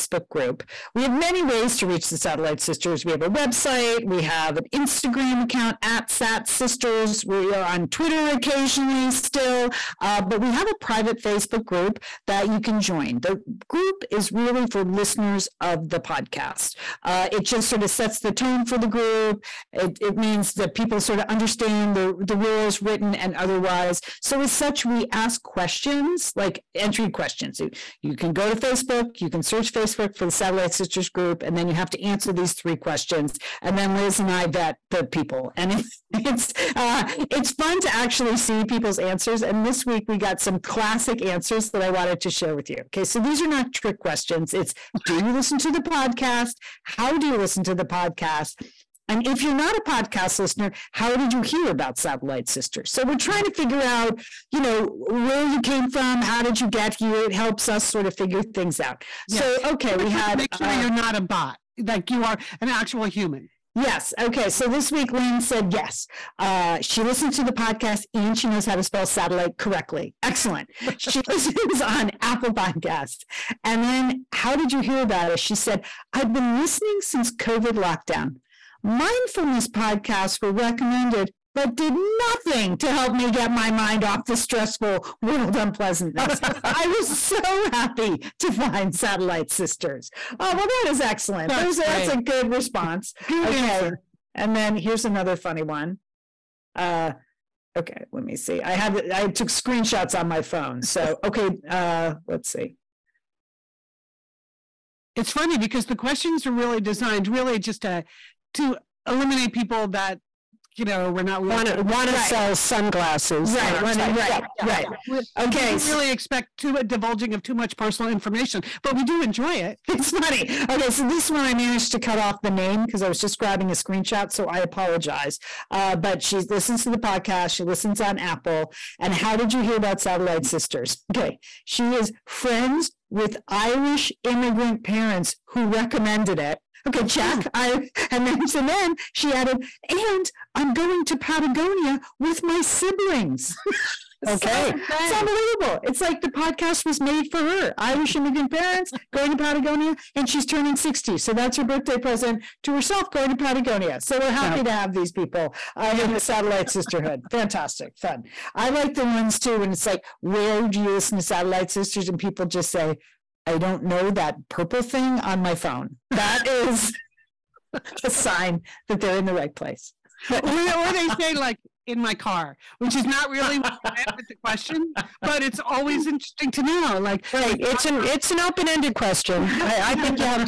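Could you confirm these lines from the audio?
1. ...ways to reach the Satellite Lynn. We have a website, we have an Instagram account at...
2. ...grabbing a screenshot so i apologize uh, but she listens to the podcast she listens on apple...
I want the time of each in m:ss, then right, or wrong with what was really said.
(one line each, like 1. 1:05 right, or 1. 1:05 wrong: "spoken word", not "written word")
1. 0:01 wrong: "Sisters", not "Lynn"
2. 2:03 right.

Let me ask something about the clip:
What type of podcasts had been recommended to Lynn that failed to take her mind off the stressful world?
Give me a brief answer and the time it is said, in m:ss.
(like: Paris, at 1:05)
Mindfulness podcasts, at 1:18.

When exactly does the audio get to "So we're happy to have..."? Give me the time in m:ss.
2:34.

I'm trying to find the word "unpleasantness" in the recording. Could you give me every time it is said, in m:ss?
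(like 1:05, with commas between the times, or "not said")
1:25.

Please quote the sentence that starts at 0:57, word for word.
It helps us sort of figure things out.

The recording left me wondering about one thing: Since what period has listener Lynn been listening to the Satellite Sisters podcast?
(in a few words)
COVID lockdown.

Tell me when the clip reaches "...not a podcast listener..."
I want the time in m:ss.
0:49.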